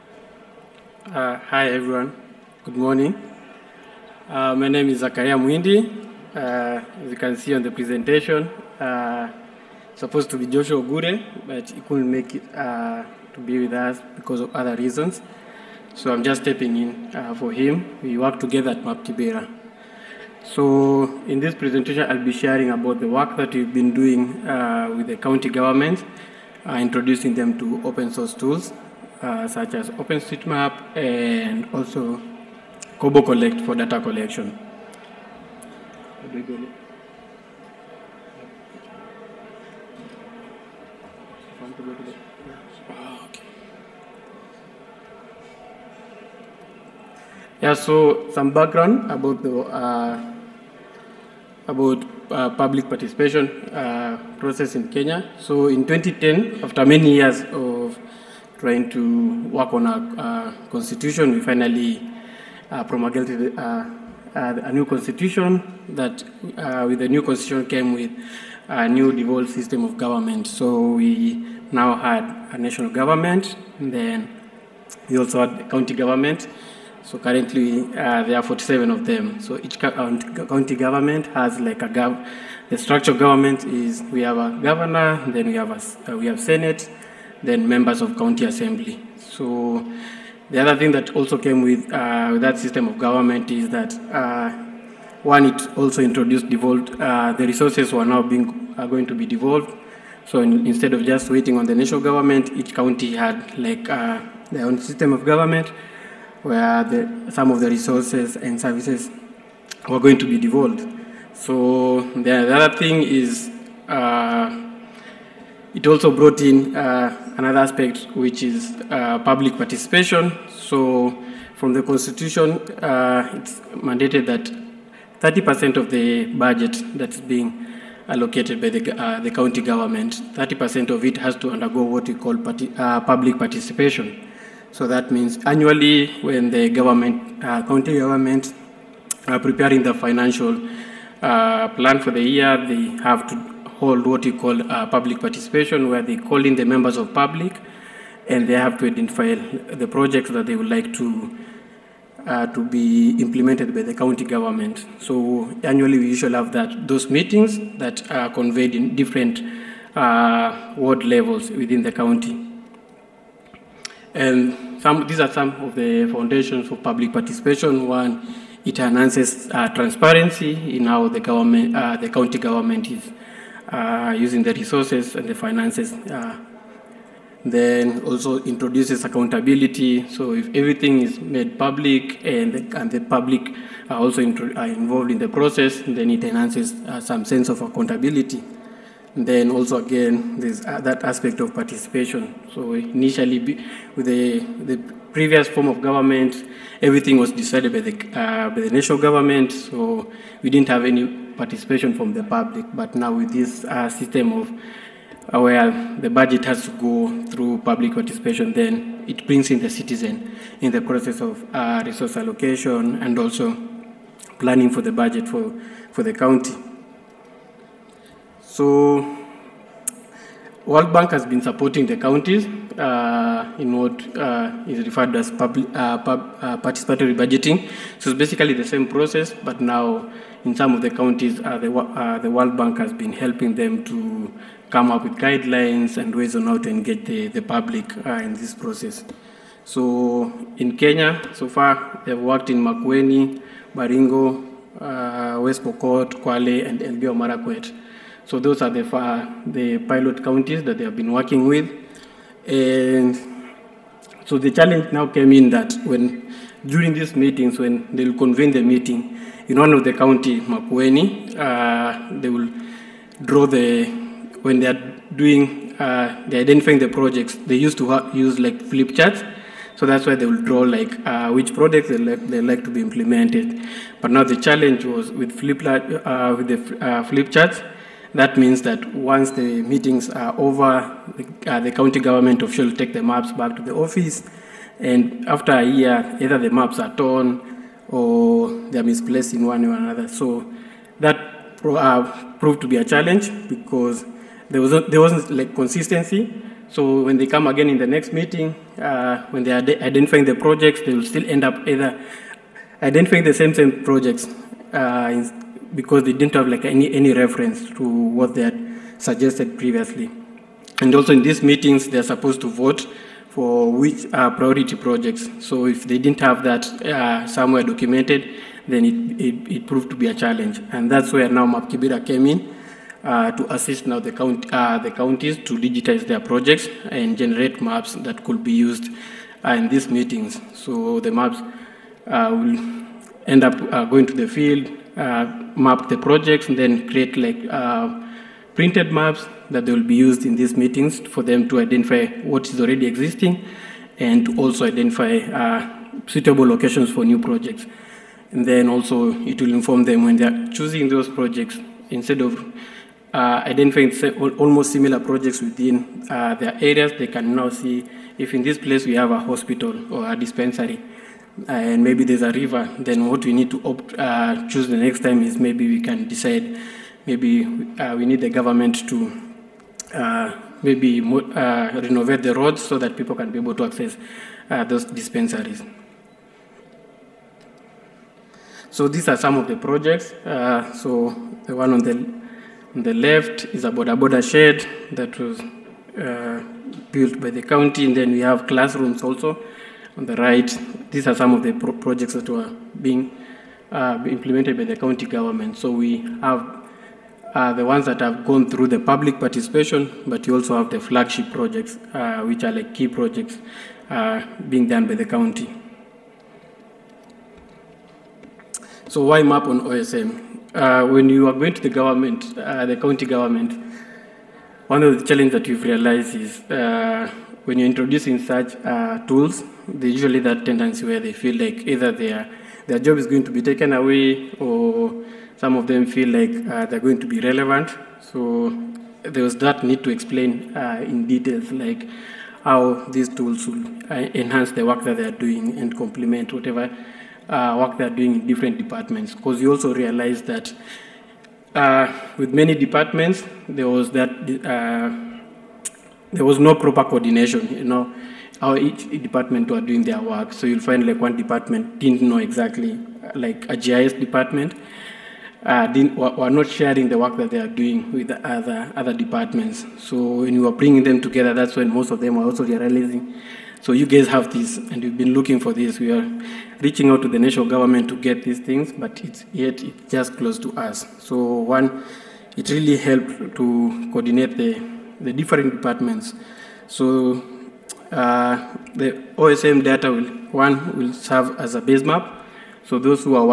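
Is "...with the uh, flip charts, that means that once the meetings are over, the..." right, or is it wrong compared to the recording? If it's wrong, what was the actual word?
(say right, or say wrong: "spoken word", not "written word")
right.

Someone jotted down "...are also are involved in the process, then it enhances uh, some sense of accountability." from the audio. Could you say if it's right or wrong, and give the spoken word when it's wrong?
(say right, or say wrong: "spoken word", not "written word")
right.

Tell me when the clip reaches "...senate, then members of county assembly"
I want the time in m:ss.
1:26.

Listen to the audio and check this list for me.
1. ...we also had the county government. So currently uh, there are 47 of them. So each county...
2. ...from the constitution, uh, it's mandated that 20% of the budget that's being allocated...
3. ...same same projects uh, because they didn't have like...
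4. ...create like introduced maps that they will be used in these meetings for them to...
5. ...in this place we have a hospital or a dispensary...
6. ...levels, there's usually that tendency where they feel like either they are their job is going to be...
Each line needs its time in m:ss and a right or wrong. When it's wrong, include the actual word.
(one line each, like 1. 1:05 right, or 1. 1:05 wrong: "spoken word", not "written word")
1. 1:15 right
2. 2:01 wrong: "30", not "20"
3. 5:03 right
4. 5:36 wrong: "printed", not "introduced"
5. 5:58 right
6. 6:59 wrong: "tools", not "levels".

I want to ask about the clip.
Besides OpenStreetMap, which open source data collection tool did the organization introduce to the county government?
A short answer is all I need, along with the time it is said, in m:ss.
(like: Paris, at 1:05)
Kobo Collect, at 0:32.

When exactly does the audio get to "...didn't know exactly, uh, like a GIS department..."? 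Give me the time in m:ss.
7:31.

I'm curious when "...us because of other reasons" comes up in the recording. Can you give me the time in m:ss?
0:13.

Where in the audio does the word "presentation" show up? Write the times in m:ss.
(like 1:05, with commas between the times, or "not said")
0:07, 0:21.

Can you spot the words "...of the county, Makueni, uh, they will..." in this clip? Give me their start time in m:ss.
4:19.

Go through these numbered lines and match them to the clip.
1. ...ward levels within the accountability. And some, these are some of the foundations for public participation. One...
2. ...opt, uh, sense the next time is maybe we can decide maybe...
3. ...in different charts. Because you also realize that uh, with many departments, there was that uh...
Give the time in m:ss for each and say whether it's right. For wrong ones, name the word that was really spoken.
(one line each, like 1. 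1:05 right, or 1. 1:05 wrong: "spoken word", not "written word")
1. 2:40 wrong: "county", not "accountability"
2. 6:03 wrong: "choose", not "sense"
3. 7:18 wrong: "departments", not "charts".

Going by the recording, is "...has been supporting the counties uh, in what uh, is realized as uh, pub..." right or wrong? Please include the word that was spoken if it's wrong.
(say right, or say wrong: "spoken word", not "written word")
wrong: "referred", not "realized".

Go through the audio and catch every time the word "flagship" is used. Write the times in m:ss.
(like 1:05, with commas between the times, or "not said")
6:40.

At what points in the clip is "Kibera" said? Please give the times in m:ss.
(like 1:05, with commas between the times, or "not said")
0:19, 5:21.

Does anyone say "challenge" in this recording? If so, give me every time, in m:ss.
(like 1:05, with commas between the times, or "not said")
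4:14, 4:34, 4:52, 5:20, 6:55.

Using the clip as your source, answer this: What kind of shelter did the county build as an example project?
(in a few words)
boda boda shed.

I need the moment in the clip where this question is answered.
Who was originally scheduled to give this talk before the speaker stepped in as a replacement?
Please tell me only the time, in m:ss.
0:10.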